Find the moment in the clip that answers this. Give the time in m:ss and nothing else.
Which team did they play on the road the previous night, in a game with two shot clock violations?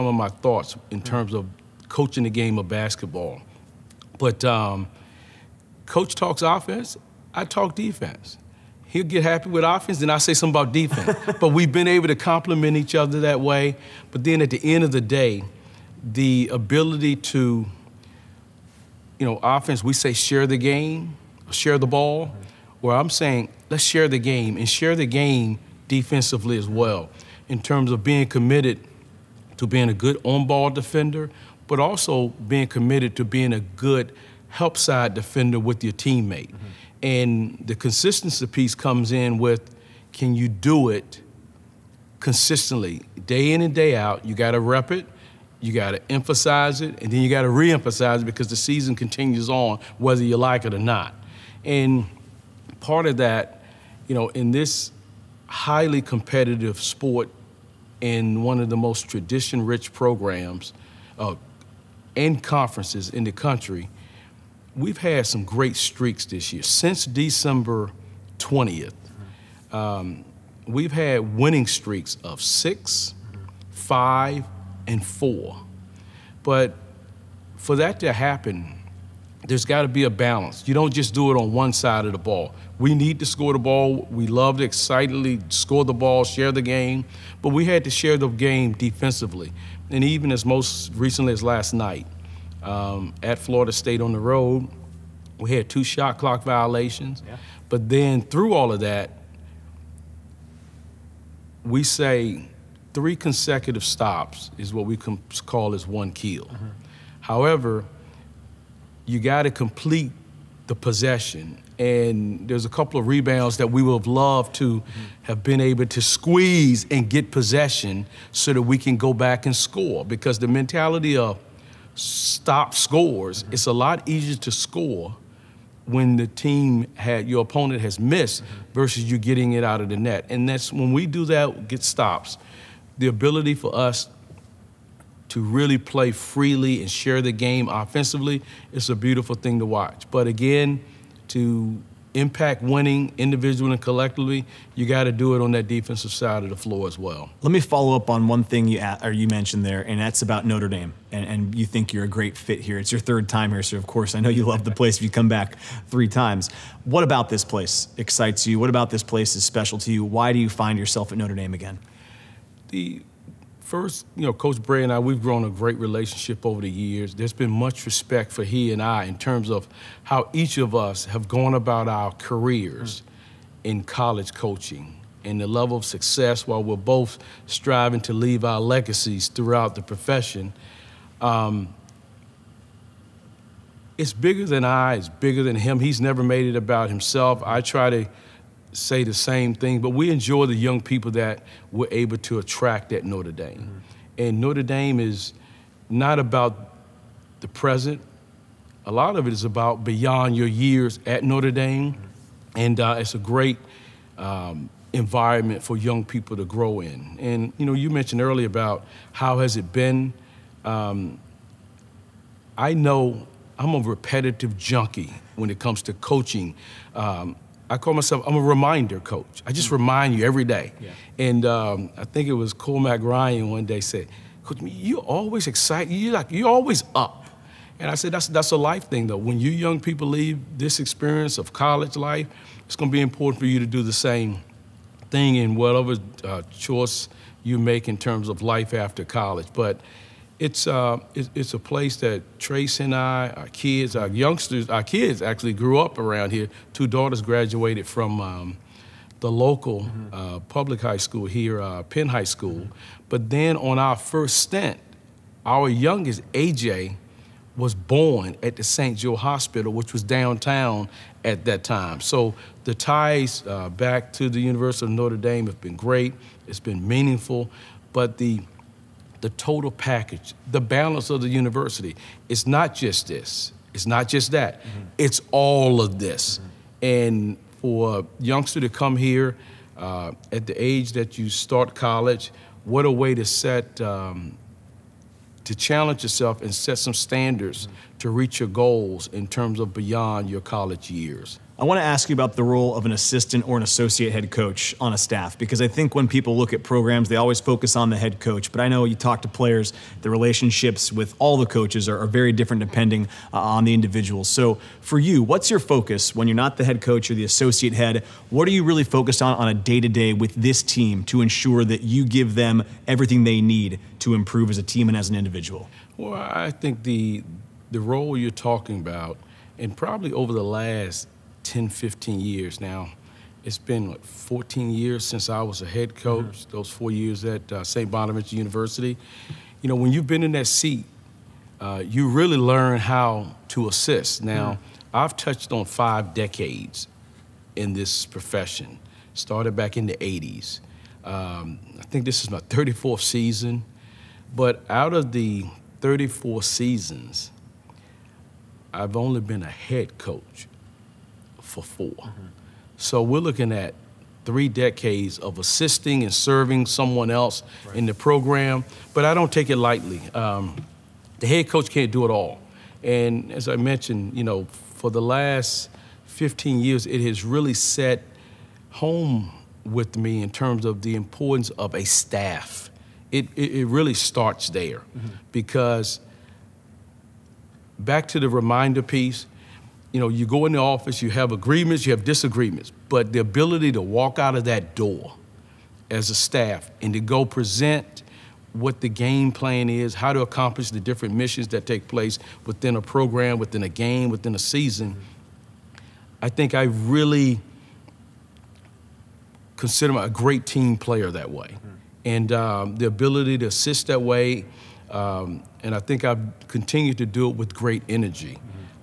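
1:33.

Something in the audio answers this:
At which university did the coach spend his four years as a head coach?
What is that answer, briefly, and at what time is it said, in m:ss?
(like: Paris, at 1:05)
St. Bonaventure University, at 5:27.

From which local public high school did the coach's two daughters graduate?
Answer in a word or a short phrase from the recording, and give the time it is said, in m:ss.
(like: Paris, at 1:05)
Penn High School, at 4:11.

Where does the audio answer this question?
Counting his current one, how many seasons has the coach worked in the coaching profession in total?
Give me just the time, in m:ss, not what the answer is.
5:42.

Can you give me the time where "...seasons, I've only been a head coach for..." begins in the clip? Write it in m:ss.
5:46.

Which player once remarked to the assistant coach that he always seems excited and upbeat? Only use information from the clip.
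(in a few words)
Cormac Ryan.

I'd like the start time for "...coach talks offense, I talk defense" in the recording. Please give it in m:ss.
0:05.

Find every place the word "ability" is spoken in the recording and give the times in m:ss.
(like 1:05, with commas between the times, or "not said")
0:16, 2:13, 6:23, 6:42.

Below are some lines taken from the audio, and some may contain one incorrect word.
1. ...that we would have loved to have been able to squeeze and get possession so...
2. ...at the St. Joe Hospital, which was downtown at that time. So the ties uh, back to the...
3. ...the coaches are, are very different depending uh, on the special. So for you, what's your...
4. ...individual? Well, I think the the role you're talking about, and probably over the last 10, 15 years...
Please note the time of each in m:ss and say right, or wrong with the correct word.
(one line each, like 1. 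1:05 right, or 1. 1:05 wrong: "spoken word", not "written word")
1. 1:53 right
2. 4:18 right
3. 5:01 wrong: "individual", not "special"
4. 5:15 right.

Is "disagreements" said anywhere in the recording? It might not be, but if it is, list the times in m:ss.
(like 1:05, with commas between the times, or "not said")
6:22.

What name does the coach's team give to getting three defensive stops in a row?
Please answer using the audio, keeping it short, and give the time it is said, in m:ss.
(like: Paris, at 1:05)
one kill, at 1:45.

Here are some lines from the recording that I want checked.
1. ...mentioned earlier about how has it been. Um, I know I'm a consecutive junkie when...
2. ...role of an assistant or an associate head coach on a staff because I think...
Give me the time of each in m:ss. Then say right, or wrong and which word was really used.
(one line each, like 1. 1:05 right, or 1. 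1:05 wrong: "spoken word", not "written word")
1. 3:27 wrong: "repetitive", not "consecutive"
2. 4:52 right.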